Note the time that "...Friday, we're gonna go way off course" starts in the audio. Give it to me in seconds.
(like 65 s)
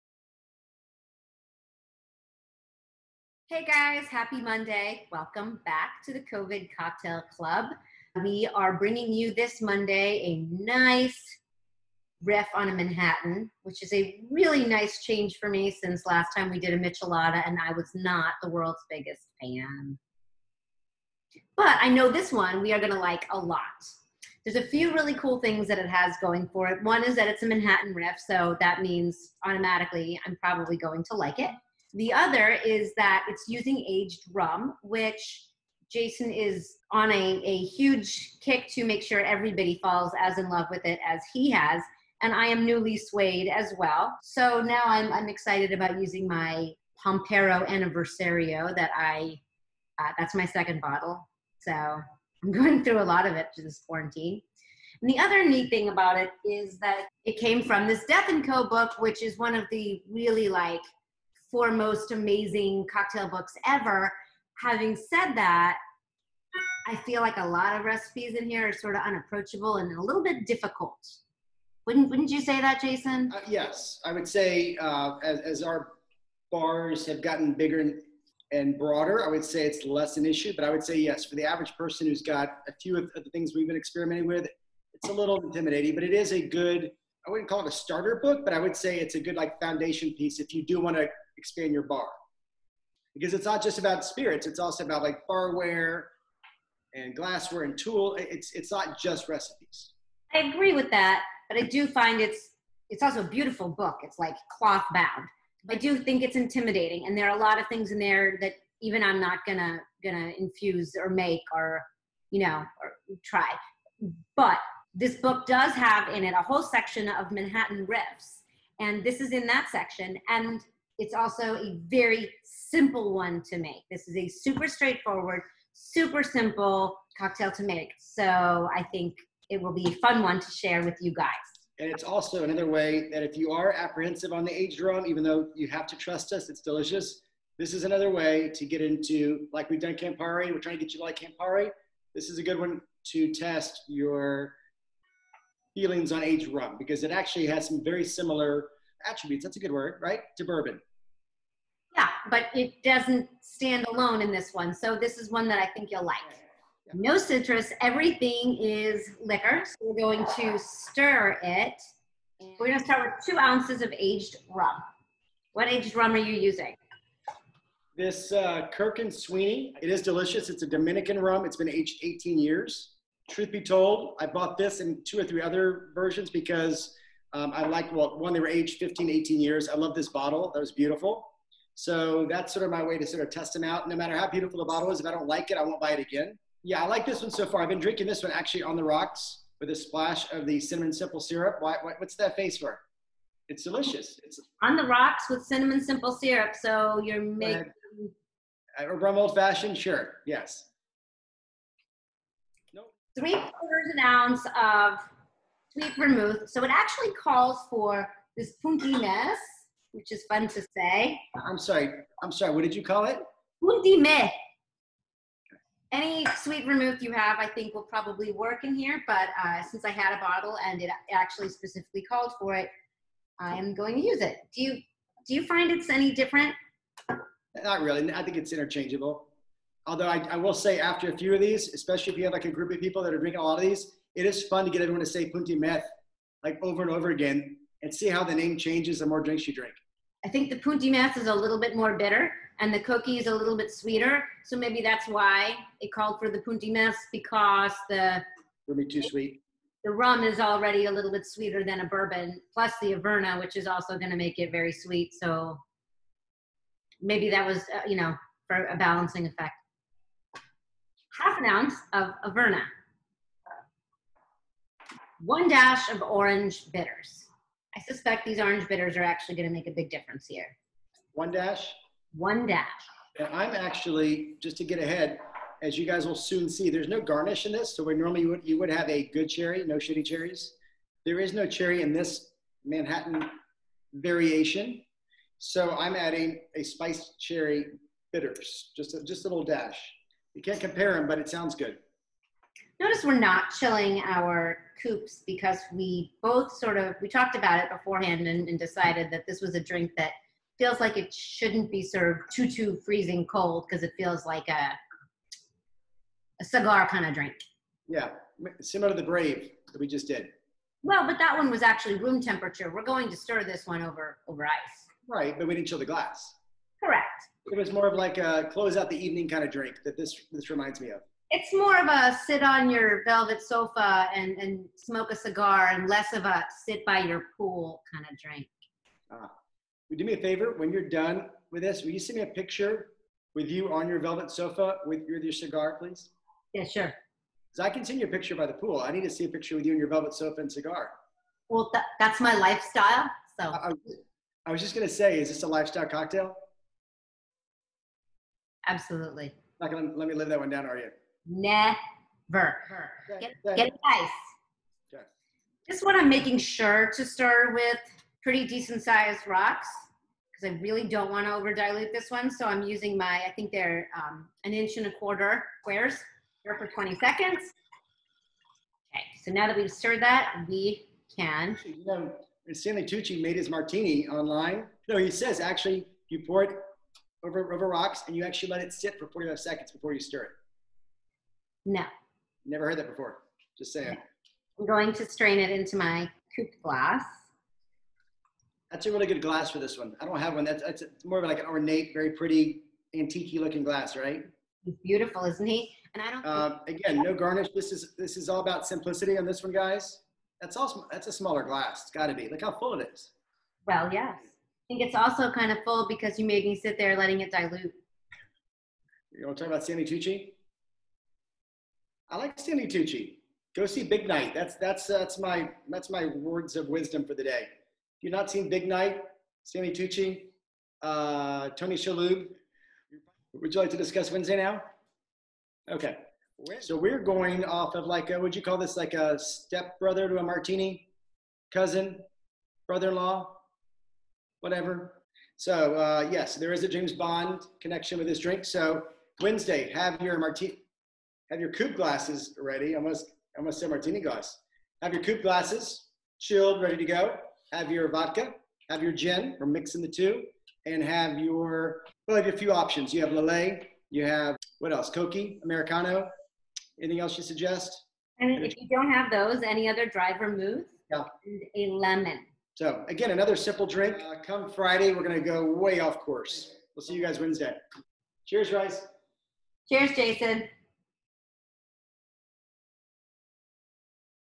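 464 s.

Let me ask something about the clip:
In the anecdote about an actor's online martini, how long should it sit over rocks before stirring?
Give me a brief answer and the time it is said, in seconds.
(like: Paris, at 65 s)
45 seconds, at 379 s.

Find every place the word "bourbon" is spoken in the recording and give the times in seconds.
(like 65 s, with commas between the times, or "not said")
150 s, 251 s.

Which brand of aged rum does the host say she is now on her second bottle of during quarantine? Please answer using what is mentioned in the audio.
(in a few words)
Pampero Aniversario.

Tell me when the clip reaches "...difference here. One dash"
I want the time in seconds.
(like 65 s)
269 s.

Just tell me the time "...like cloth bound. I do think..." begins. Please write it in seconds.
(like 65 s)
104 s.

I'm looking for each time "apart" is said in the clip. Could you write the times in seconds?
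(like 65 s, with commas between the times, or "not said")
not said.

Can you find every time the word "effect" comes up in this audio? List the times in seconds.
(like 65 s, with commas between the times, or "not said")
259 s.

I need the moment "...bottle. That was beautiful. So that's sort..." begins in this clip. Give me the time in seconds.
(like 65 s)
180 s.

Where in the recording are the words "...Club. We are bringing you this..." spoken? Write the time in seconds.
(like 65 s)
7 s.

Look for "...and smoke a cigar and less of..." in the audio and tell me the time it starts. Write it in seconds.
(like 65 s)
324 s.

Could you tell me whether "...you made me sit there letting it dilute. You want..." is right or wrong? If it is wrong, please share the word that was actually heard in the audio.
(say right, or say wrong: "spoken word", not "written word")
right.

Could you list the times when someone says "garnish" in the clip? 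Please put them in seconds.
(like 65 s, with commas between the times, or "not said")
277 s, 397 s.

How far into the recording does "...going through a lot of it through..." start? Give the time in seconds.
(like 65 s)
52 s.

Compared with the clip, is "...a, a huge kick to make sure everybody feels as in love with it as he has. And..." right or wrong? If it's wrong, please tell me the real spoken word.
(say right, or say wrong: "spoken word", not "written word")
wrong: "falls", not "feels".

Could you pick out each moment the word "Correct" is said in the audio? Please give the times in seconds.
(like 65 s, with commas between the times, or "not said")
316 s.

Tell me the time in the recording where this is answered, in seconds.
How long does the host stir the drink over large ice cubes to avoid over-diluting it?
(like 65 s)
366 s.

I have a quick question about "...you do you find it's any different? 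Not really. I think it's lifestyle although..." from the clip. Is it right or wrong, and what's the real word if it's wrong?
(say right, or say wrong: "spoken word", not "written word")
wrong: "interchangeable", not "lifestyle".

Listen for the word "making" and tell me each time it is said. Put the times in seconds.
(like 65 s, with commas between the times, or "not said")
197 s, 356 s.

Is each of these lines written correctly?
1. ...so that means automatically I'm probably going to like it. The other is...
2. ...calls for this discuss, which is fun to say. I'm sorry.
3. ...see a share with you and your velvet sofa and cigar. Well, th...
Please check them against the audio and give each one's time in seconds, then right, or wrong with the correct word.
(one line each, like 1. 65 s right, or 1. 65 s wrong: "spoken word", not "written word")
1. 28 s right
2. 207 s wrong: "punkiness", not "discuss"
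3. 339 s wrong: "picture", not "share".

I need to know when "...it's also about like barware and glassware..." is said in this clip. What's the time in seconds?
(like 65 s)
94 s.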